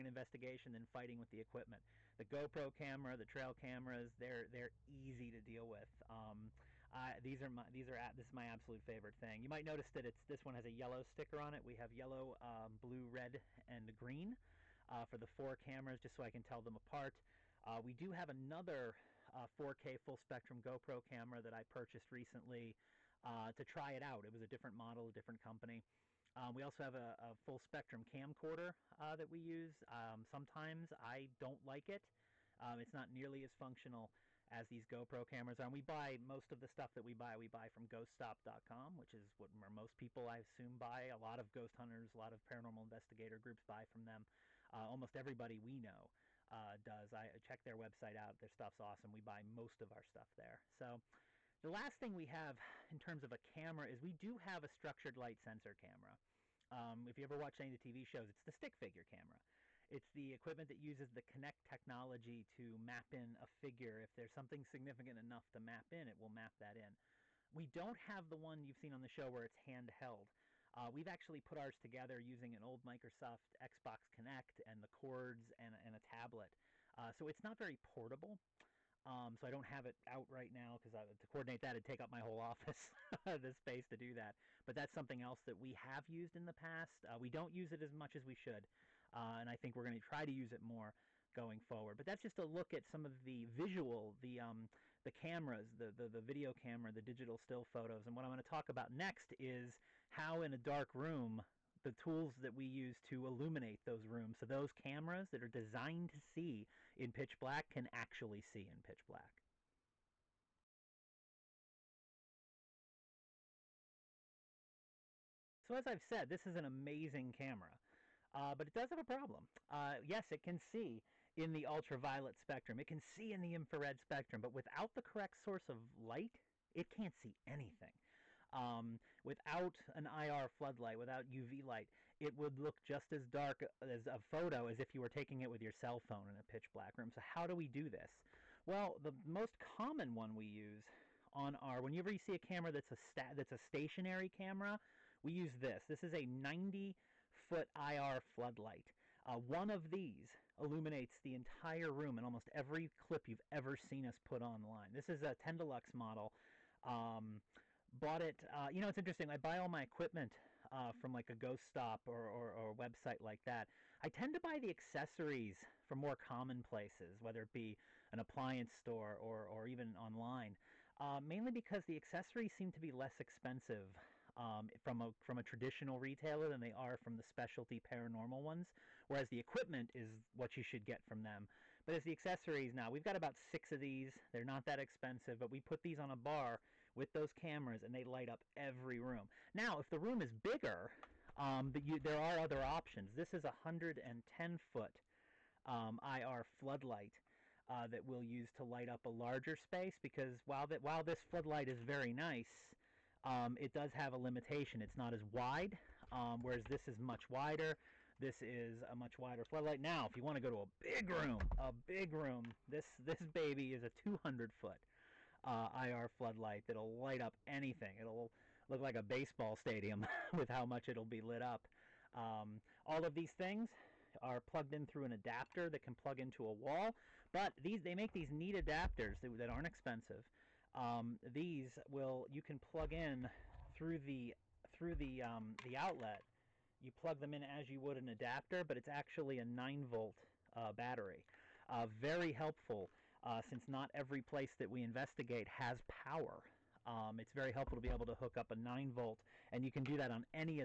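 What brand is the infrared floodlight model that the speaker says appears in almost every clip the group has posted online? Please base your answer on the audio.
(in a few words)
Tendelux.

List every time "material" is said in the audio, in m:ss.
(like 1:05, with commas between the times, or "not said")
not said.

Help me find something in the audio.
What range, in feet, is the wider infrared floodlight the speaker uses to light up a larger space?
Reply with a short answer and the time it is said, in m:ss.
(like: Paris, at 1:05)
110 foot, at 3:13.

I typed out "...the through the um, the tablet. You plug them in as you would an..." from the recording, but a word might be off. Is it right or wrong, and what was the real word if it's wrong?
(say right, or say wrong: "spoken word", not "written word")
wrong: "outlet", not "tablet".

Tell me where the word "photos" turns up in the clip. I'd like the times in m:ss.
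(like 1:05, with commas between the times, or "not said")
1:37, 2:14.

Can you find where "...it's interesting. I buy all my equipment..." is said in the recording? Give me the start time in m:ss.
2:38.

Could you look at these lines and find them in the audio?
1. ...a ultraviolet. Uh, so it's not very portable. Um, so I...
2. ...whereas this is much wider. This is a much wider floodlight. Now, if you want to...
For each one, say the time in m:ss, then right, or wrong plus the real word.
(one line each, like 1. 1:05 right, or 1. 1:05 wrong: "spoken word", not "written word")
1. 1:15 wrong: "tablet", not "ultraviolet"
2. 3:26 right.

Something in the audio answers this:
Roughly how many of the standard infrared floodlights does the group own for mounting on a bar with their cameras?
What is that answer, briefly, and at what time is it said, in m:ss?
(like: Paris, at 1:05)
about 6, at 3:03.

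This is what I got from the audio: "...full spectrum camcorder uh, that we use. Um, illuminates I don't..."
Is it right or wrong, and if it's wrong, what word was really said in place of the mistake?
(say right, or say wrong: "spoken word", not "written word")
wrong: "sometimes", not "illuminates".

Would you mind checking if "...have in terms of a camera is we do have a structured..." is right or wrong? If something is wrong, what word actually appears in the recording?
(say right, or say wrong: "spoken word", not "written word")
right.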